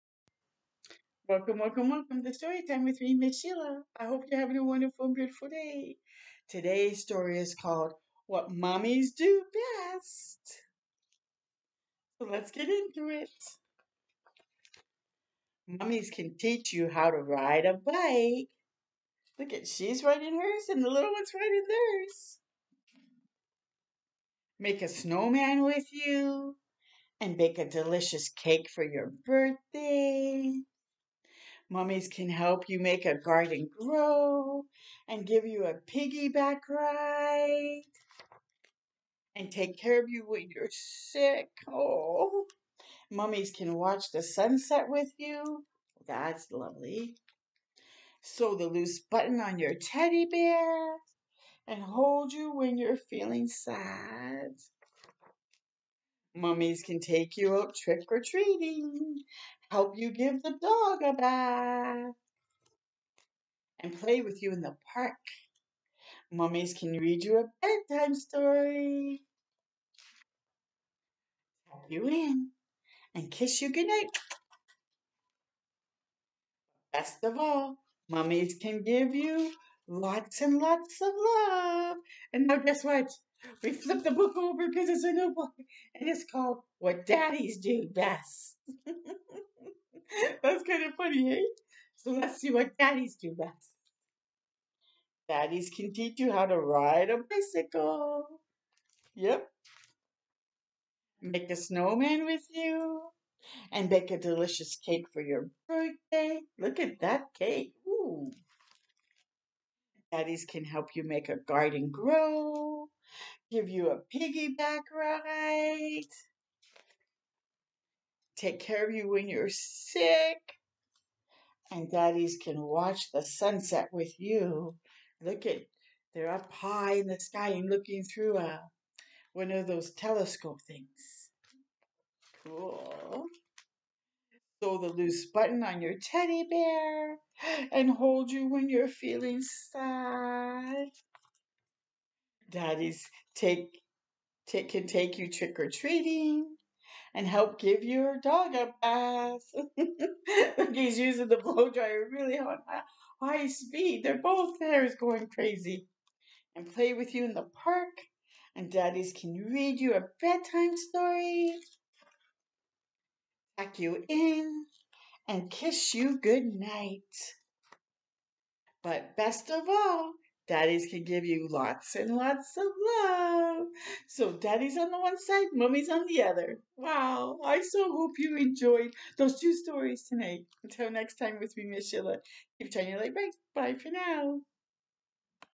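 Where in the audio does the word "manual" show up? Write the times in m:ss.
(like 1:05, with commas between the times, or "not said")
not said.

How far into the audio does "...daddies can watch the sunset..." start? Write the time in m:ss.
2:01.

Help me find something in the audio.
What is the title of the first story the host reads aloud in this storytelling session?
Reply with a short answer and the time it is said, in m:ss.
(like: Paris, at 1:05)
What Mommies Do Best, at 0:08.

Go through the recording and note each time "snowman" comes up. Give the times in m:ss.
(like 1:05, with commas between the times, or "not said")
0:24, 1:41.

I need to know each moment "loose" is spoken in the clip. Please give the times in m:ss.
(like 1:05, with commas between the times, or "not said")
0:48, 2:14.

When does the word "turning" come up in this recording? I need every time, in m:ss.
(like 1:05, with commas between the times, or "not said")
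3:02.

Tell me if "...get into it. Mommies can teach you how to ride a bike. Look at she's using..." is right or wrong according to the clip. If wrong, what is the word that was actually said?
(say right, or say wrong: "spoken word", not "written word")
wrong: "riding", not "using".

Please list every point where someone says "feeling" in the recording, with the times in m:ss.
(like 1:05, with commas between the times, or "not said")
0:52, 2:18.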